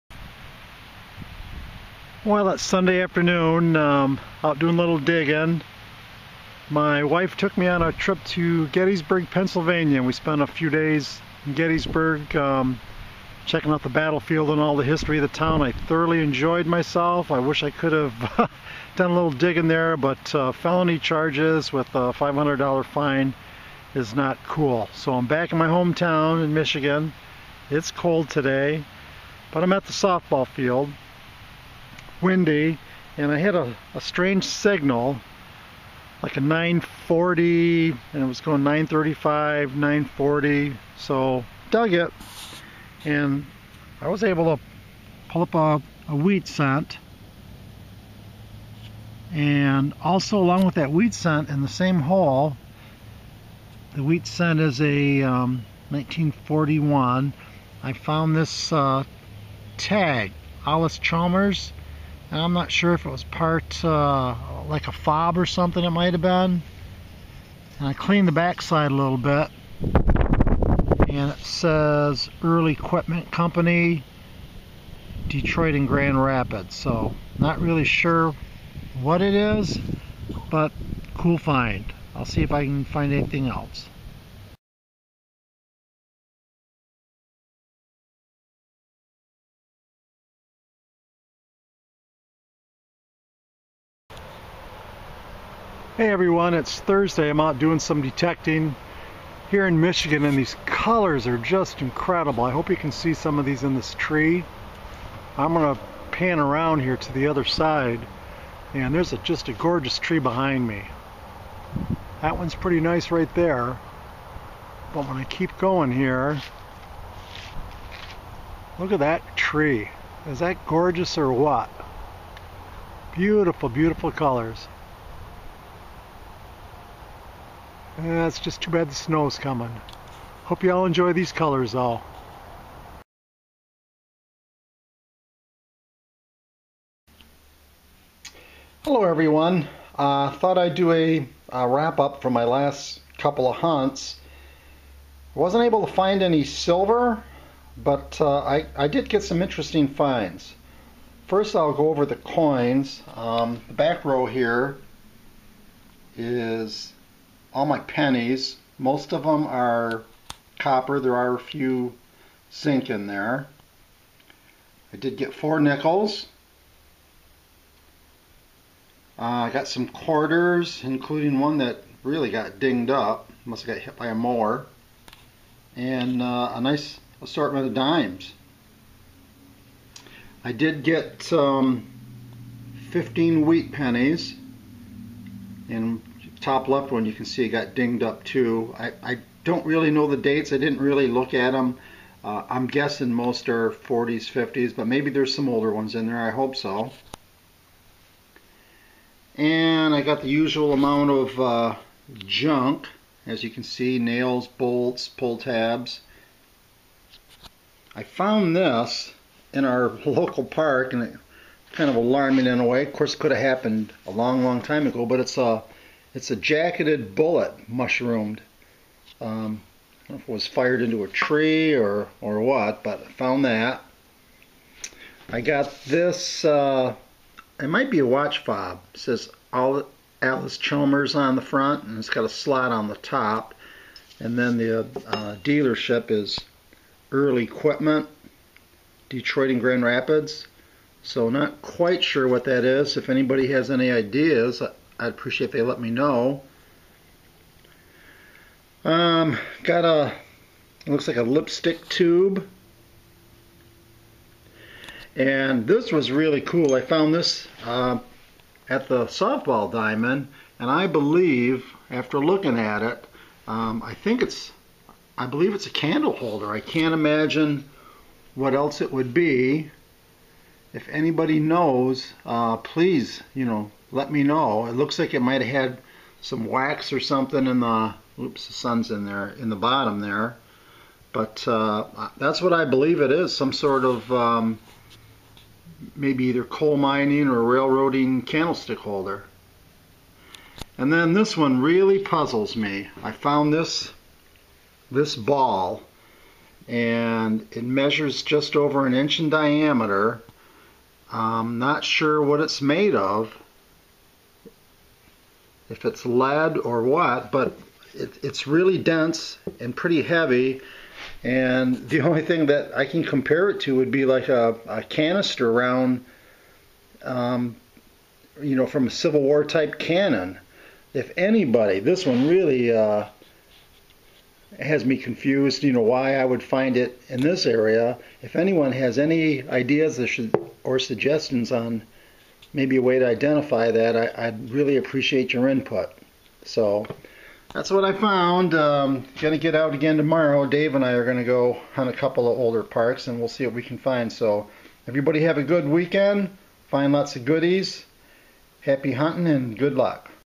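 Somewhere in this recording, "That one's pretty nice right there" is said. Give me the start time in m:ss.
1:52.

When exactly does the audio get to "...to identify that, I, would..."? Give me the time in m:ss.
5:32.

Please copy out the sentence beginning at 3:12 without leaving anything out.
Uh, I'm guessing most are 40s, 50s, but maybe there's some older ones in there.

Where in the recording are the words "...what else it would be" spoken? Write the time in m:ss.
4:28.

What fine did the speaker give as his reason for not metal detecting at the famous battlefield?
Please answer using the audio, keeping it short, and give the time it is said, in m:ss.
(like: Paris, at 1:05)
$500, at 0:22.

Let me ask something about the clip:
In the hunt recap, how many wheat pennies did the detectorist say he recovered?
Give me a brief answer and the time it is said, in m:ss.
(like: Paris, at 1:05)
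15, at 3:02.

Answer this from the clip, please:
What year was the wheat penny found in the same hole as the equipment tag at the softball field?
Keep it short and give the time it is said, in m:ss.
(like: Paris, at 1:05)
1941, at 0:55.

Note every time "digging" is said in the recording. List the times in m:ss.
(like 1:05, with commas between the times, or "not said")
0:04, 0:19.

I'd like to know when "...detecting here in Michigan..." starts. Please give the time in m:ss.
1:38.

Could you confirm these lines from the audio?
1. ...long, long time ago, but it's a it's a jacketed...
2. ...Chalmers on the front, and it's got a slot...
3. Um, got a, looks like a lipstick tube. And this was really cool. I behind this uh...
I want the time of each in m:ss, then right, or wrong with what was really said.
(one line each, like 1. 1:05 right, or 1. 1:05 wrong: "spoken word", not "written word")
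1. 3:34 right
2. 3:50 right
3. 4:08 wrong: "found", not "behind".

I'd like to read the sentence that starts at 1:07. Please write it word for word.
And I cleaned the backside a little bit.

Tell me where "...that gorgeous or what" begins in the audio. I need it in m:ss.
2:00.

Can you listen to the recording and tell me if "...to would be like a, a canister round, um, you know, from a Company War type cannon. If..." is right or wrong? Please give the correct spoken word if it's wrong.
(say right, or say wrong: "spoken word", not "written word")
wrong: "Civil", not "Company".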